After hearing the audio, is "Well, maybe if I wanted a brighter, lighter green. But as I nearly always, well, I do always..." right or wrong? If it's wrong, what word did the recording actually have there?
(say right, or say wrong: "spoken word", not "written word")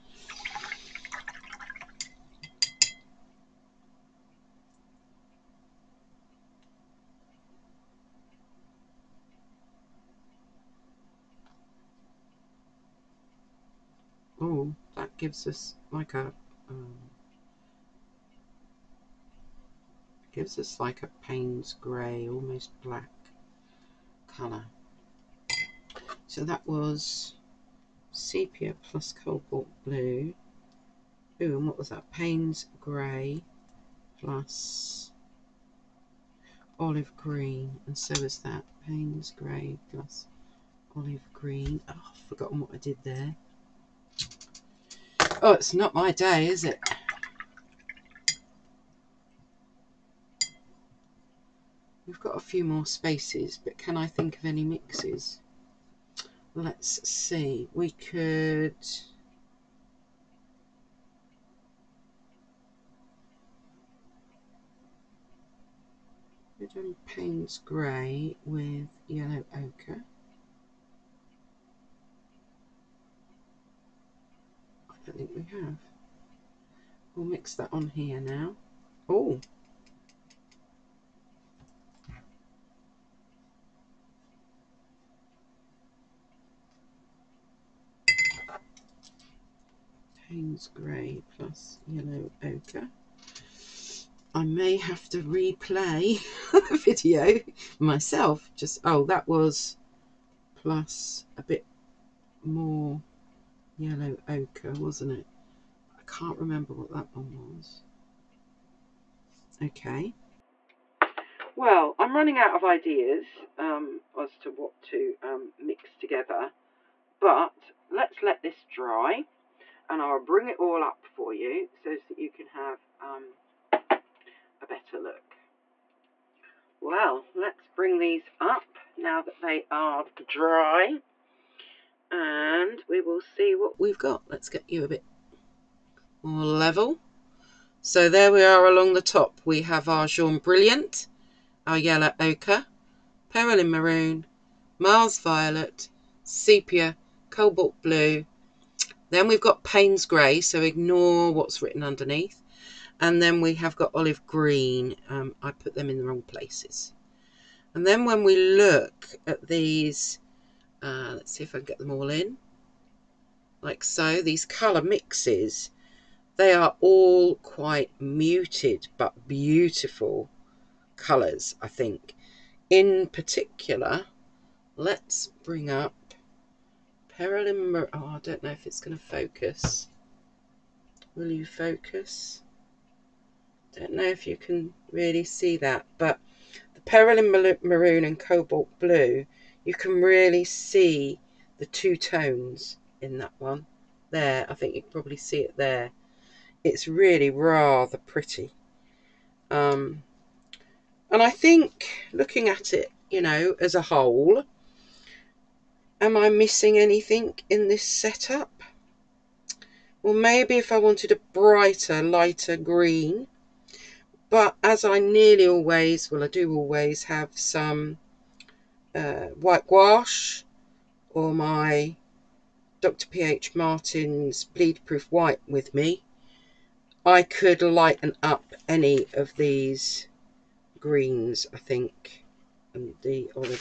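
right.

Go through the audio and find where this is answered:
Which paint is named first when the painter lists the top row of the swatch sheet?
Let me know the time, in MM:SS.
02:20.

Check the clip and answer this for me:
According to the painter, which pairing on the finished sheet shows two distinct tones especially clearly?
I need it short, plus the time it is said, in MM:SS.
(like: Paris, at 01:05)
Perylene Maroon and Cobalt Blue, at 03:06.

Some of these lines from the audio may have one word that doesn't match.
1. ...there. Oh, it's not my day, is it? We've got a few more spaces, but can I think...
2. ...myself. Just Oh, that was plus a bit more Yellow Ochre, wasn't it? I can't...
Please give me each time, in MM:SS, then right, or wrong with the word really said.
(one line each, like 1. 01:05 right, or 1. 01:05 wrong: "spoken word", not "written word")
1. 00:43 right
2. 01:37 right.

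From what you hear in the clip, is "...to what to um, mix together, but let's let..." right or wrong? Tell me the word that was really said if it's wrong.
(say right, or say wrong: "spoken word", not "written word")
right.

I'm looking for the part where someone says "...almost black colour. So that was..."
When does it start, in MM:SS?
00:22.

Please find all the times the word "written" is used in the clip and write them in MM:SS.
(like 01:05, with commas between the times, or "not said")
02:31.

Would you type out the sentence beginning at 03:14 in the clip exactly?
There, I think you can probably see it there.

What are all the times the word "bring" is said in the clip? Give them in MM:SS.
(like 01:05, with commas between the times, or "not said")
02:00, 02:07, 02:55.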